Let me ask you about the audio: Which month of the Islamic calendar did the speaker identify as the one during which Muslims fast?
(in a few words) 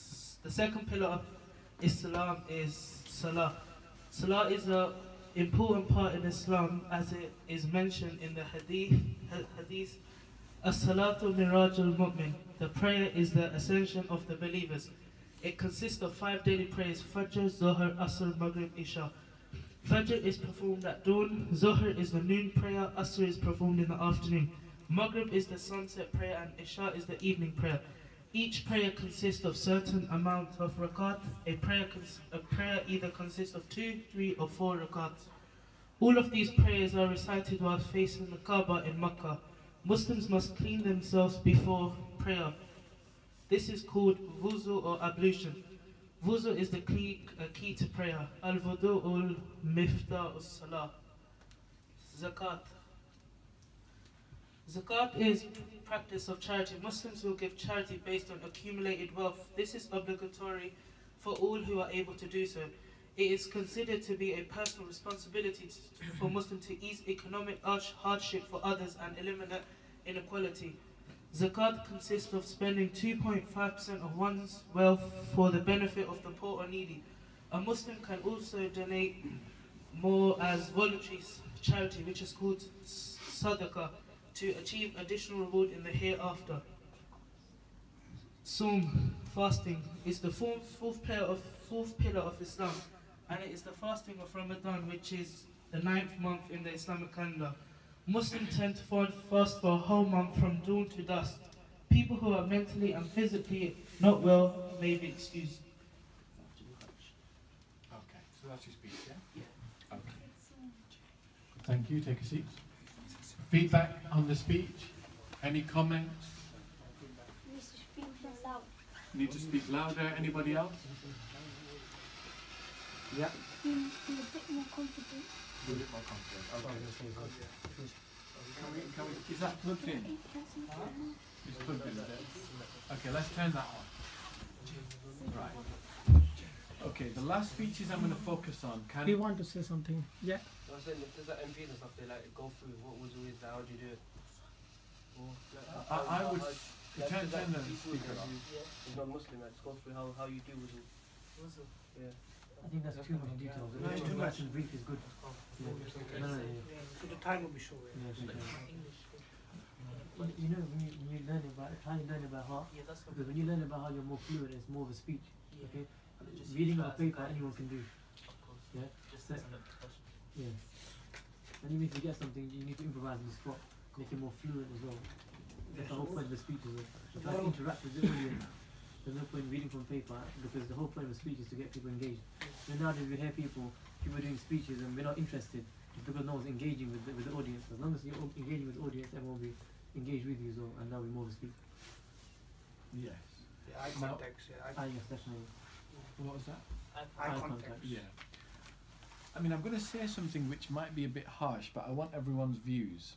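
Ninth.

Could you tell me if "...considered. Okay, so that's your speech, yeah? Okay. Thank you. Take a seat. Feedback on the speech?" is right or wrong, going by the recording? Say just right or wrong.
wrong.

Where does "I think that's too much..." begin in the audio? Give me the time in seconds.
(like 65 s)
152 s.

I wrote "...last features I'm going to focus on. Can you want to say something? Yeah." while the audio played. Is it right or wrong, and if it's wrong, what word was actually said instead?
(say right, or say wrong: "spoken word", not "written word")
right.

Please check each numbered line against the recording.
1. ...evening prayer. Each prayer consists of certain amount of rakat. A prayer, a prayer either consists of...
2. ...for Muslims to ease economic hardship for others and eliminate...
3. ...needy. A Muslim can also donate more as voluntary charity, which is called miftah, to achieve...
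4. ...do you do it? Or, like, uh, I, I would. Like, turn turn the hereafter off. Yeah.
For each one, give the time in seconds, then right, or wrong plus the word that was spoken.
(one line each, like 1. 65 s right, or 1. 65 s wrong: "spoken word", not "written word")
1. 27 s right
2. 66 s right
3. 76 s wrong: "sadaqah", not "miftah"
4. 143 s wrong: "speaker", not "hereafter".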